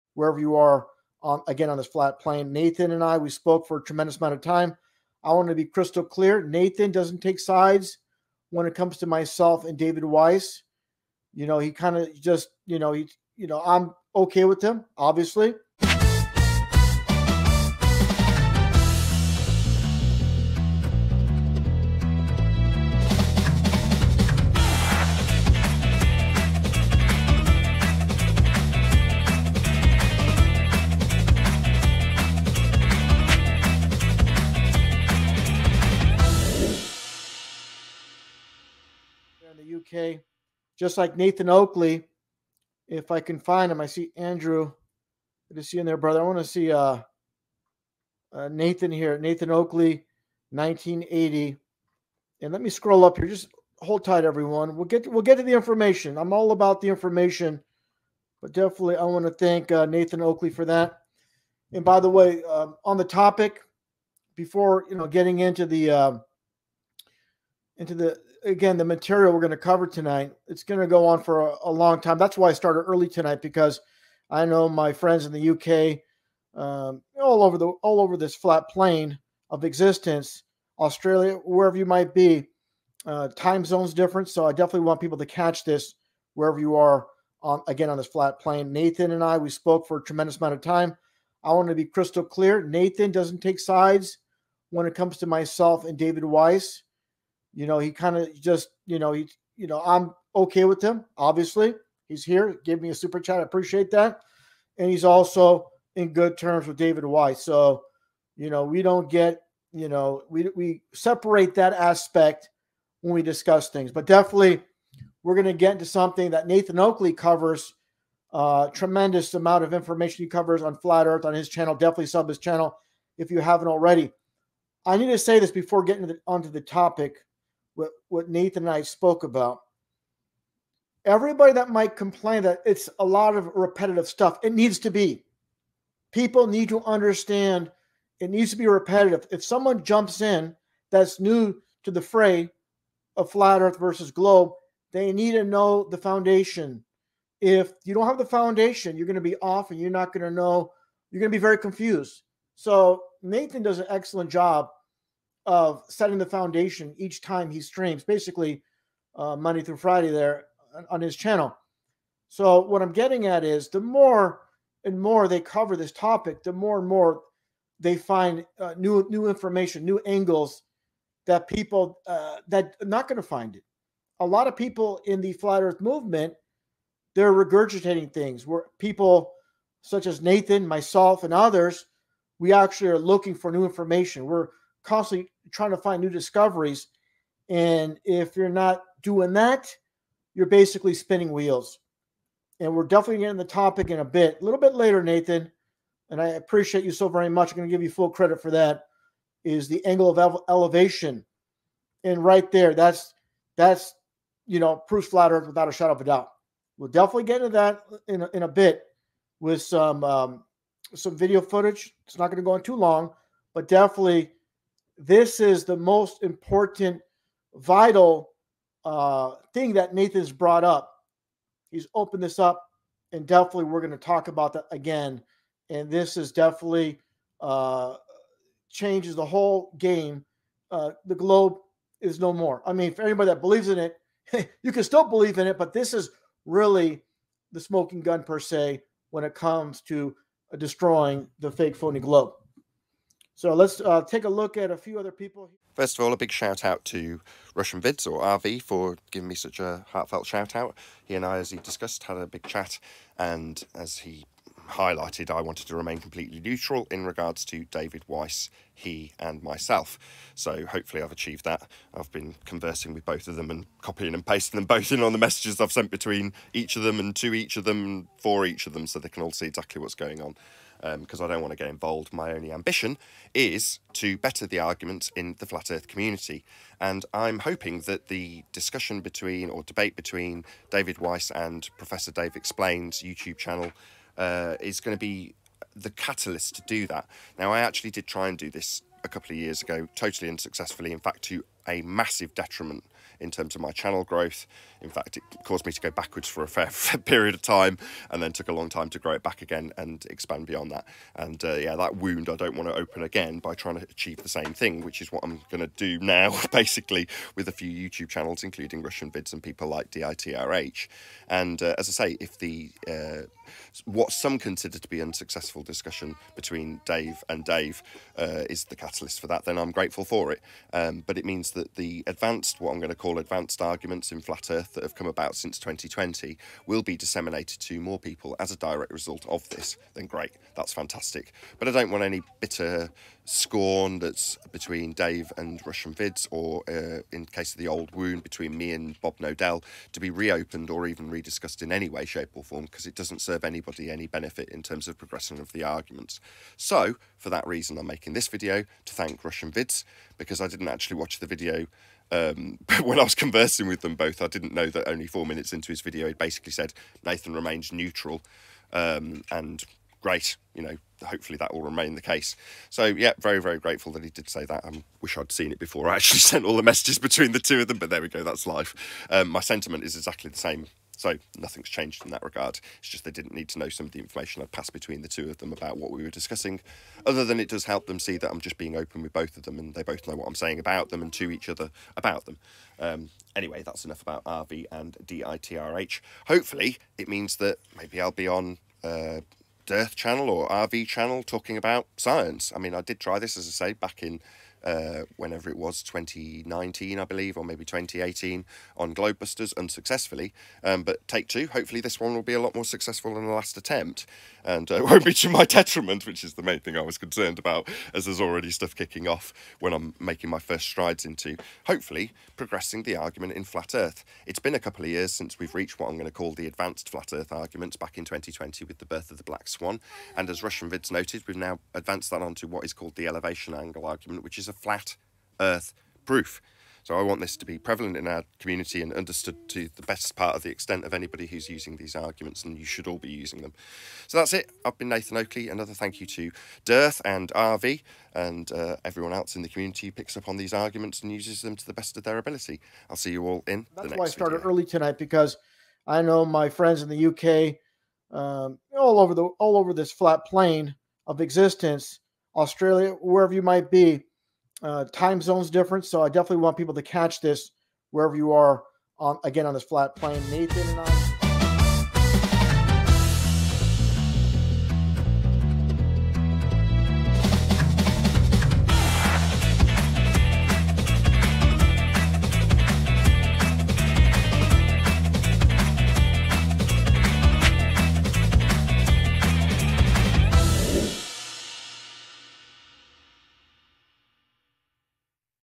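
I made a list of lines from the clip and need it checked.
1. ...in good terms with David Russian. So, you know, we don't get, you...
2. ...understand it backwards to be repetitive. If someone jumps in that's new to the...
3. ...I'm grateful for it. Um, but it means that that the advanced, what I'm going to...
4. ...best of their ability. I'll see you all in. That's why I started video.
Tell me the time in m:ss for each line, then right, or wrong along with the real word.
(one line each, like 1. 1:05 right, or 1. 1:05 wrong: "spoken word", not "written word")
1. 1:45 wrong: "Weiss", not "Russian"
2. 2:16 wrong: "needs", not "backwards"
3. 5:19 right
4. 7:21 right.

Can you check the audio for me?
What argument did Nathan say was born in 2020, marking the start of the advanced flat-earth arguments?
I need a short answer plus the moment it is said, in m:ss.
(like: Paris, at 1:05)
the black swan, at 6:59.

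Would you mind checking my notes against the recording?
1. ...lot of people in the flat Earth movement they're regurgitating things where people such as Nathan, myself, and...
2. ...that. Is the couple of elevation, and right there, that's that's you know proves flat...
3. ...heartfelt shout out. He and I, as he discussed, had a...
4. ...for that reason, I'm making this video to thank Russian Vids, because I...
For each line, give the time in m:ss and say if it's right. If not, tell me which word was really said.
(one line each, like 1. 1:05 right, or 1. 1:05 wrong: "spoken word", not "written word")
1. 2:54 right
2. 3:18 wrong: "angle", not "couple"
3. 4:09 right
4. 5:47 right.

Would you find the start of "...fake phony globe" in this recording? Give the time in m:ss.
4:01.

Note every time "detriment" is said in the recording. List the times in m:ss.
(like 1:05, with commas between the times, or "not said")
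4:52, 6:45.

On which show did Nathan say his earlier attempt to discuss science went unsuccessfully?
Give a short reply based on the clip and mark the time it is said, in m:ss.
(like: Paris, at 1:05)
Globebusters, at 6:38.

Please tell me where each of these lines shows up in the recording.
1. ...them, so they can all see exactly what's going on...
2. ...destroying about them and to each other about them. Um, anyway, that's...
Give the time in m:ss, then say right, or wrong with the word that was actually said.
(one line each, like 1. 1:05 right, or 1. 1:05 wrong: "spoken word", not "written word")
1. 4:28 right
2. 6:20 wrong: "saying", not "destroying".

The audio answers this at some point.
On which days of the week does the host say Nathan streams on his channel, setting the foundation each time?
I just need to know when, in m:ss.
2:39.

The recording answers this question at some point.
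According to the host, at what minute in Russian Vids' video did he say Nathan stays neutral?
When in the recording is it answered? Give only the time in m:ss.
5:55.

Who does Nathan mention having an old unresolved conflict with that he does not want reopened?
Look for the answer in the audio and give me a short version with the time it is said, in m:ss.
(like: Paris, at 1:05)
Bob Knodel, at 5:39.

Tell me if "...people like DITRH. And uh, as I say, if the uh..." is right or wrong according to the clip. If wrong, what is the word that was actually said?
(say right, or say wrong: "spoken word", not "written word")
right.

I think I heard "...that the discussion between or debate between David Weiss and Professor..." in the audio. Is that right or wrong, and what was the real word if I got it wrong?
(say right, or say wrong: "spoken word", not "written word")
right.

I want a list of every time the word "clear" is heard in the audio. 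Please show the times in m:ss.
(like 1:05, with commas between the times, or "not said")
0:06, 1:32.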